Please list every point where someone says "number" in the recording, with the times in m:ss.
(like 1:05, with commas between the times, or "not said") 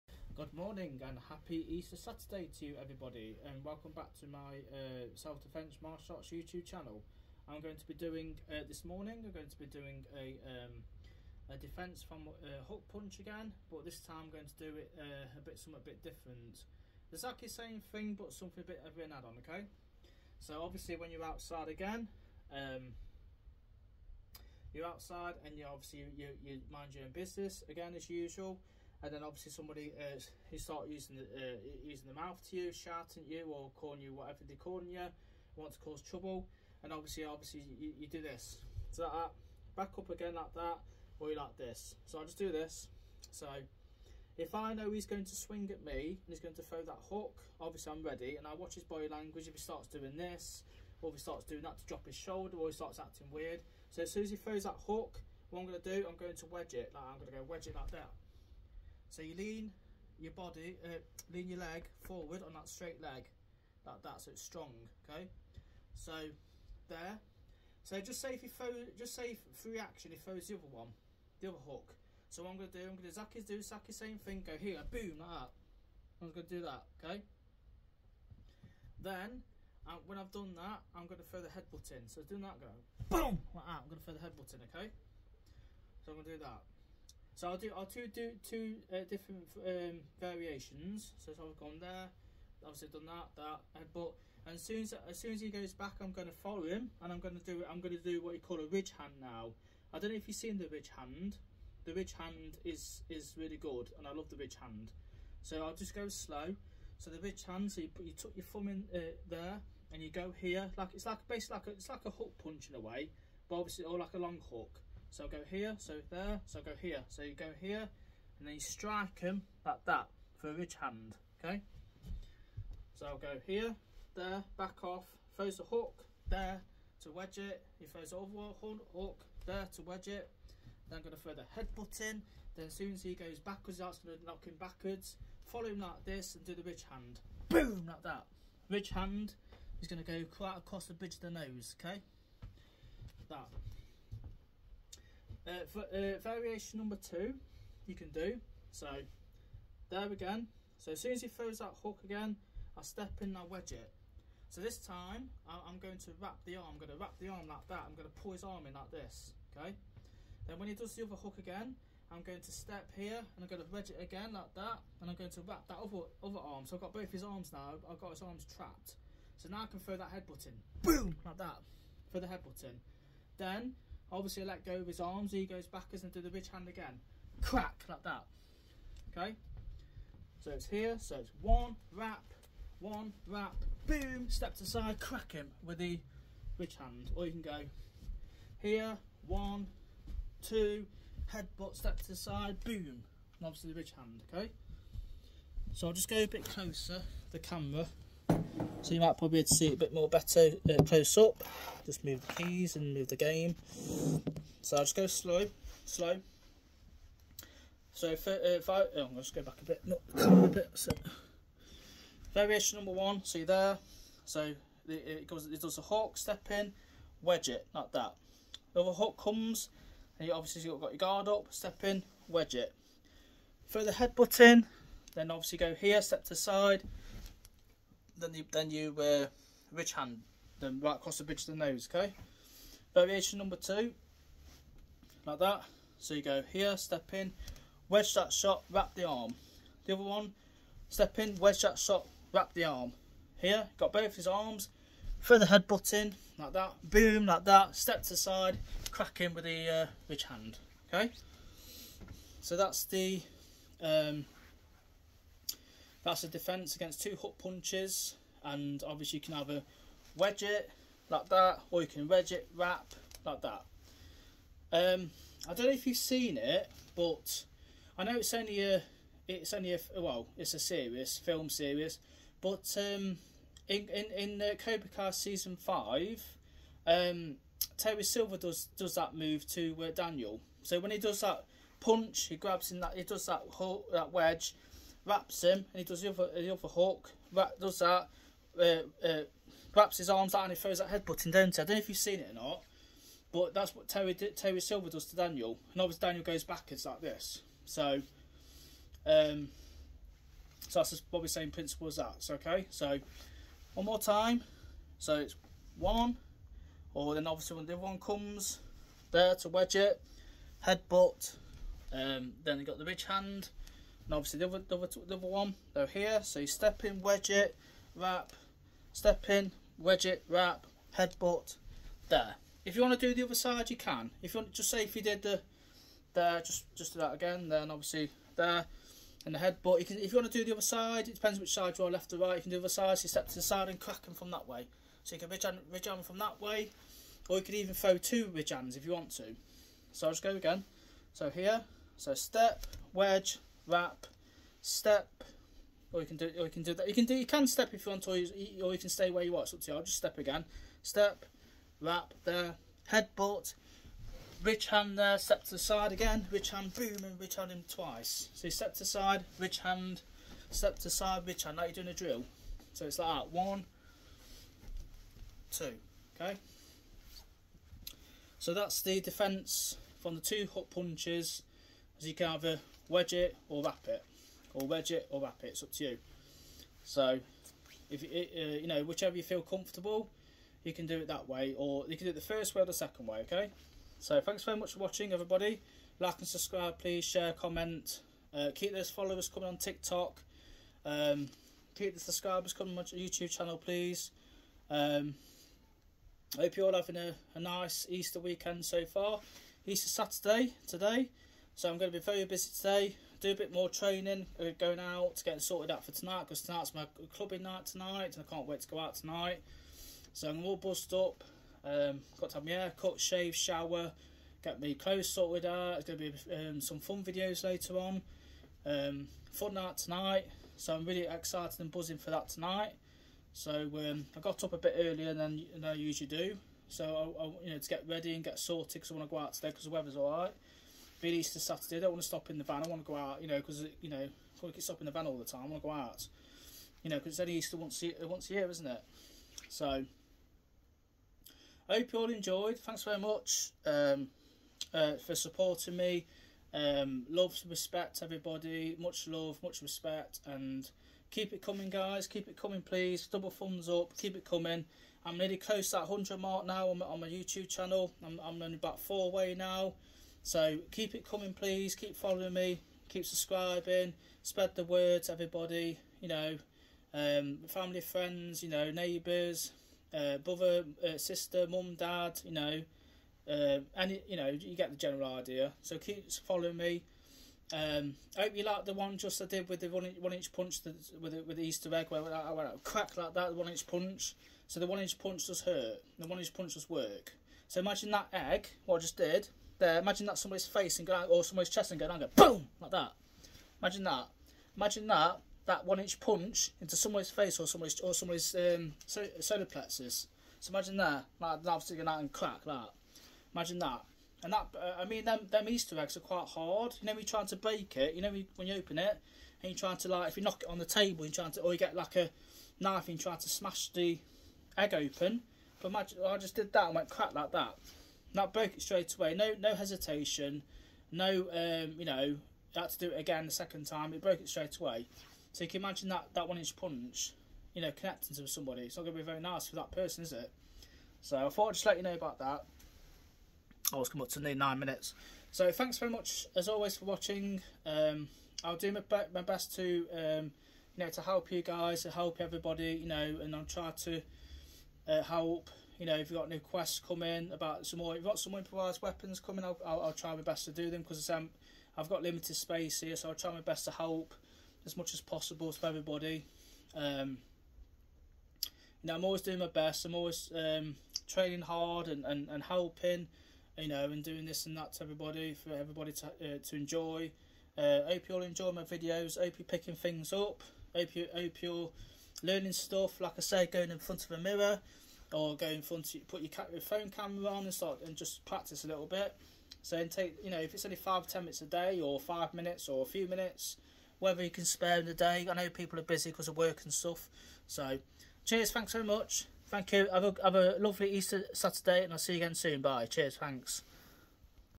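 2:26, 3:32, 3:53.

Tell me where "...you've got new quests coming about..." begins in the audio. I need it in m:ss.
9:06.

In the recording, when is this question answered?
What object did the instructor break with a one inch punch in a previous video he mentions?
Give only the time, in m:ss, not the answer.
8:01.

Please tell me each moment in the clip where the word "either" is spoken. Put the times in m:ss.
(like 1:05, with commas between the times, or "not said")
4:19, 6:12.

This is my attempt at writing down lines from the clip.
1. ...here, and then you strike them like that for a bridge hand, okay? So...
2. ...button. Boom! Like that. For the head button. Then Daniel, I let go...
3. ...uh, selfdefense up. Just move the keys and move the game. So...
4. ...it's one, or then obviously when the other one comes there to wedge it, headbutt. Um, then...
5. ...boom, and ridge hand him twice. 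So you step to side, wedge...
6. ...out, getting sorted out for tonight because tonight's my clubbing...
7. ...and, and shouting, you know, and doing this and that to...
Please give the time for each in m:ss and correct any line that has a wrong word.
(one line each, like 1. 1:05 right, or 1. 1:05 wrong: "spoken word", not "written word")
1. 1:57 wrong: "ridge", not "bridge"
2. 2:50 wrong: "Obviously", not "Daniel"
3. 3:20 wrong: "close", not "selfdefense"
4. 5:05 right
5. 5:56 wrong: "ridge", not "wedge"
6. 6:44 right
7. 9:22 wrong: "helping", not "shouting".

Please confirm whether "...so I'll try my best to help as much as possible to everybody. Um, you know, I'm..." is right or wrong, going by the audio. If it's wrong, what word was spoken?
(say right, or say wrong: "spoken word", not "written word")
right.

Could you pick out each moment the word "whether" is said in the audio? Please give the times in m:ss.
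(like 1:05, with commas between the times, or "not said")
9:43.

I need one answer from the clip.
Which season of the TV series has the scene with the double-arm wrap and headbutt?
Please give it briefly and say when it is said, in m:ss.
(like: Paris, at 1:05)
Season 5, at 4:35.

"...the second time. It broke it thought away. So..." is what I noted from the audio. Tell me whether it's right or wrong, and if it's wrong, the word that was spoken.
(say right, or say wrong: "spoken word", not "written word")
wrong: "straight", not "thought".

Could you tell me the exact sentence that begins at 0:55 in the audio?
What I'm going to do, I'm going to wedge it.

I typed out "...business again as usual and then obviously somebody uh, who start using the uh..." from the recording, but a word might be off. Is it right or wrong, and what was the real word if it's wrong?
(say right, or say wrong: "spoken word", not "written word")
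right.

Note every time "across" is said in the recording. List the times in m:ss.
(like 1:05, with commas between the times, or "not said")
2:20, 3:50.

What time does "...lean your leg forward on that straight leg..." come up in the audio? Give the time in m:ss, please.
1:01.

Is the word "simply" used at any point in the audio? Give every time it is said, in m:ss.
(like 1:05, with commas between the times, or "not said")
not said.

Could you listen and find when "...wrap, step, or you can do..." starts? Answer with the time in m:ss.
5:43.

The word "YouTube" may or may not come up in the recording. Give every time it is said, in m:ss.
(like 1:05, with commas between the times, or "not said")
0:06, 6:32, 7:37.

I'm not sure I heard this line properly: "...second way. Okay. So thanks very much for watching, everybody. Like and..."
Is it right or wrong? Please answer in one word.
right.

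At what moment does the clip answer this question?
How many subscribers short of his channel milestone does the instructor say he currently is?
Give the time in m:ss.
7:38.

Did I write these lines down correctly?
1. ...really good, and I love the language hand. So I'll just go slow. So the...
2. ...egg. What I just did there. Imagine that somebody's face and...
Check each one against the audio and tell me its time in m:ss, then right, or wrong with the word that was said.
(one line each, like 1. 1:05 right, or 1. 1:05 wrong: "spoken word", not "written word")
1. 1:43 wrong: "ridge", not "language"
2. 8:08 right.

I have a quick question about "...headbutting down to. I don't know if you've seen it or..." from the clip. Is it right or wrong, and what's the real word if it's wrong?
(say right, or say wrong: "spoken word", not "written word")
right.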